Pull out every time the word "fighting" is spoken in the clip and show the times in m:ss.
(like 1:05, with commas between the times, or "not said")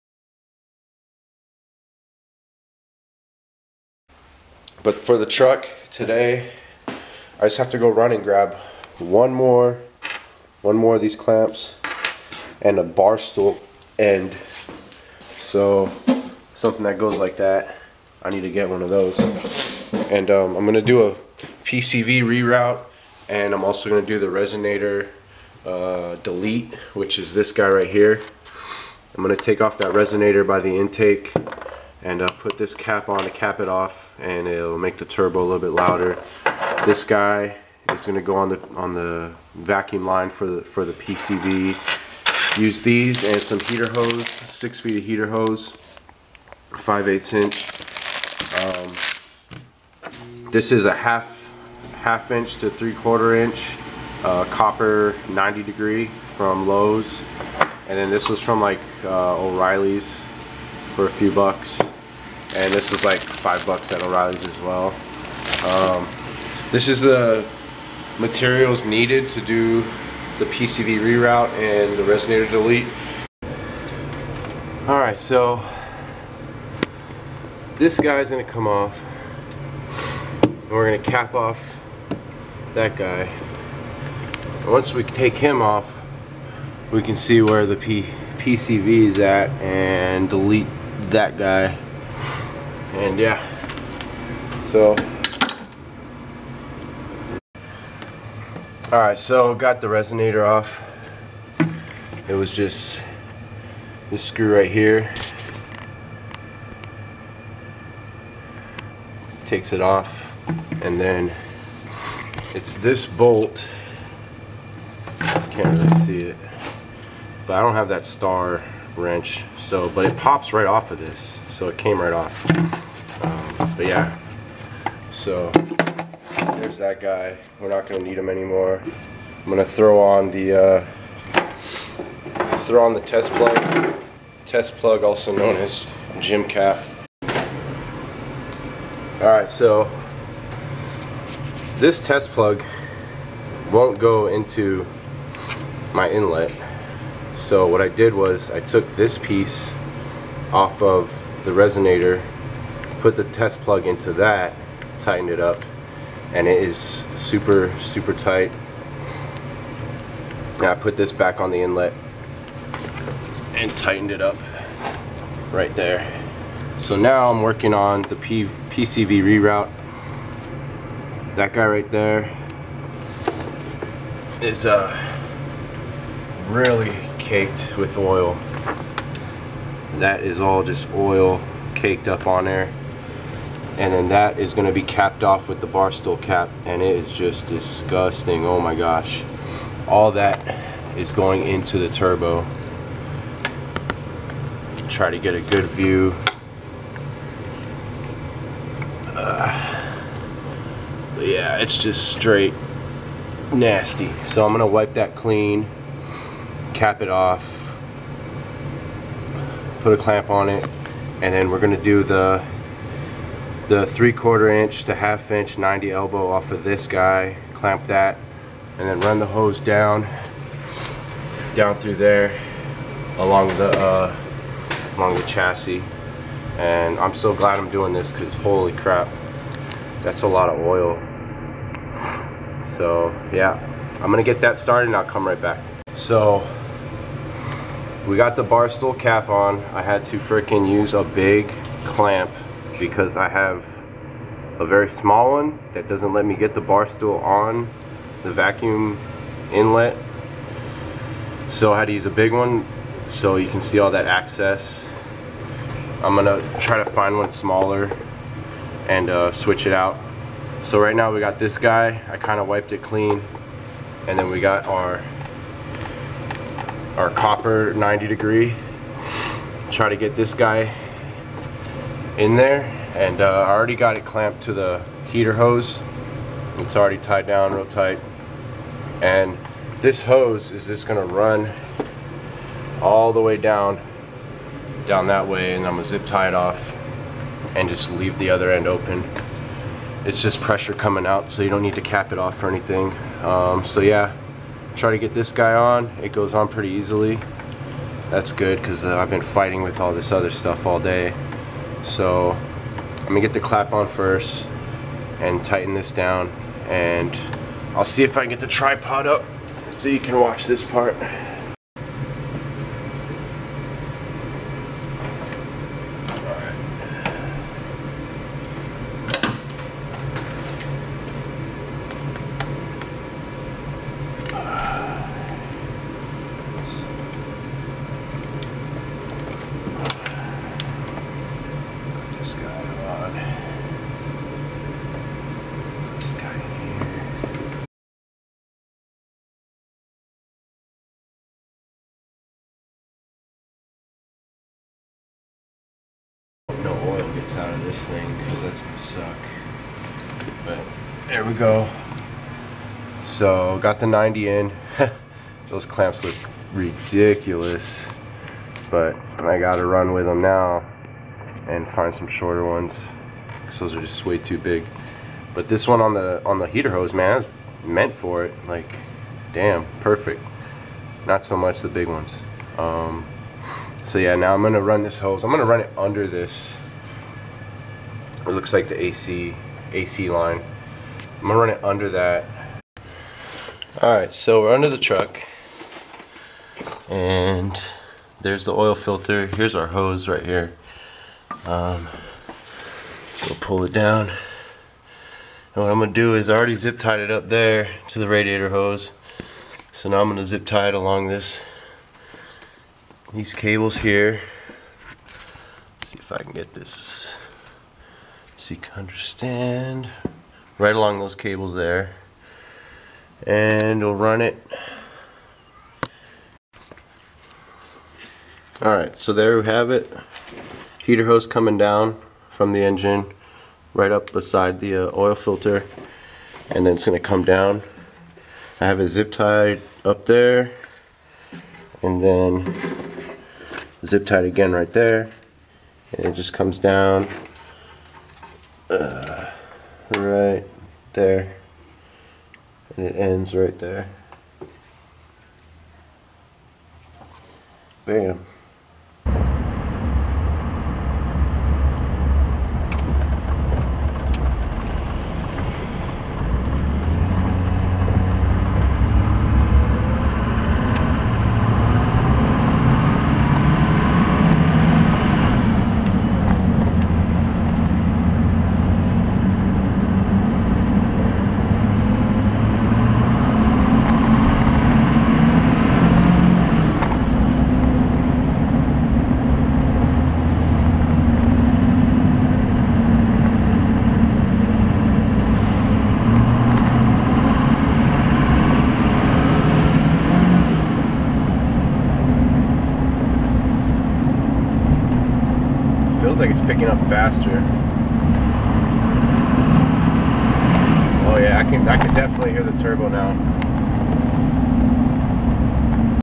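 4:59.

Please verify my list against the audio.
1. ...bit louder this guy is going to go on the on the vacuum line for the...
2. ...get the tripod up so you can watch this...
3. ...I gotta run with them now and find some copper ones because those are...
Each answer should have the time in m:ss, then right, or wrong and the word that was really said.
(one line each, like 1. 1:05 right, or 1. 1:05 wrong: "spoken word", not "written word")
1. 0:35 right
2. 5:08 right
3. 5:59 wrong: "shorter", not "copper".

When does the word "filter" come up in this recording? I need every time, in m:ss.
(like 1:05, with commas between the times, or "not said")
6:28, 7:05.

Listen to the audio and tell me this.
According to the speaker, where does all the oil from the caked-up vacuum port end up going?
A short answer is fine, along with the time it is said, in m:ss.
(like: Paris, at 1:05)
Into the turbo, at 3:11.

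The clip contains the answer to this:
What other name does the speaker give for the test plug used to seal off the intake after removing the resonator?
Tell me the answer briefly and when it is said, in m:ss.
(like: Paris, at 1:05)
Gym cap, at 2:16.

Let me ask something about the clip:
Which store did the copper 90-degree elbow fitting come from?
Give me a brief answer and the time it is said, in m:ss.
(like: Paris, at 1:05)
Lowe's, at 0:56.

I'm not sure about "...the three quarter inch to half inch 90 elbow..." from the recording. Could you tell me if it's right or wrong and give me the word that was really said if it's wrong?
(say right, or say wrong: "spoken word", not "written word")
right.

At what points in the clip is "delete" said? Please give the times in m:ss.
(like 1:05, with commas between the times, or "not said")
0:26, 1:12, 1:30.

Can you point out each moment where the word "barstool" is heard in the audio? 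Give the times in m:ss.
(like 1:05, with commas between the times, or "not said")
3:05, 3:58, 4:06.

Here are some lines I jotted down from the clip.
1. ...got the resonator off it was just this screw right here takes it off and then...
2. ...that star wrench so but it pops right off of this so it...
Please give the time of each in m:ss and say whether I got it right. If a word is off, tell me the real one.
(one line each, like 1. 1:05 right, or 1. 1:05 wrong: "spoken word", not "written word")
1. 1:39 right
2. 1:57 right.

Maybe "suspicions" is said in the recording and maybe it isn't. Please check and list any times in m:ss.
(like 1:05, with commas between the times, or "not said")
not said.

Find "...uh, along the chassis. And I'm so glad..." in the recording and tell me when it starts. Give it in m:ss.
3:43.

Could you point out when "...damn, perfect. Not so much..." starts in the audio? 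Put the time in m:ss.
6:09.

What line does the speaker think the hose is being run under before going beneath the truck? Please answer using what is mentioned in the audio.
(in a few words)
AC line.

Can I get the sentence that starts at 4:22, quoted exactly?
I kind of wiped it clean and then we got our our copper 90 degree.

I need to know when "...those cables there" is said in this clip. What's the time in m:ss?
6:50.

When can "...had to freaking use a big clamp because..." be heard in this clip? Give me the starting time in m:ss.
3:59.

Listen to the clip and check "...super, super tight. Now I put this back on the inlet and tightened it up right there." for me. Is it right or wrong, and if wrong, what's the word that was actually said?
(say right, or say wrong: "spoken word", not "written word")
right.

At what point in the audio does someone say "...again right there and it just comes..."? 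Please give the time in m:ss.
7:14.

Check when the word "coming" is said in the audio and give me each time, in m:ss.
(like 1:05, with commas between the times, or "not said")
4:50, 7:01.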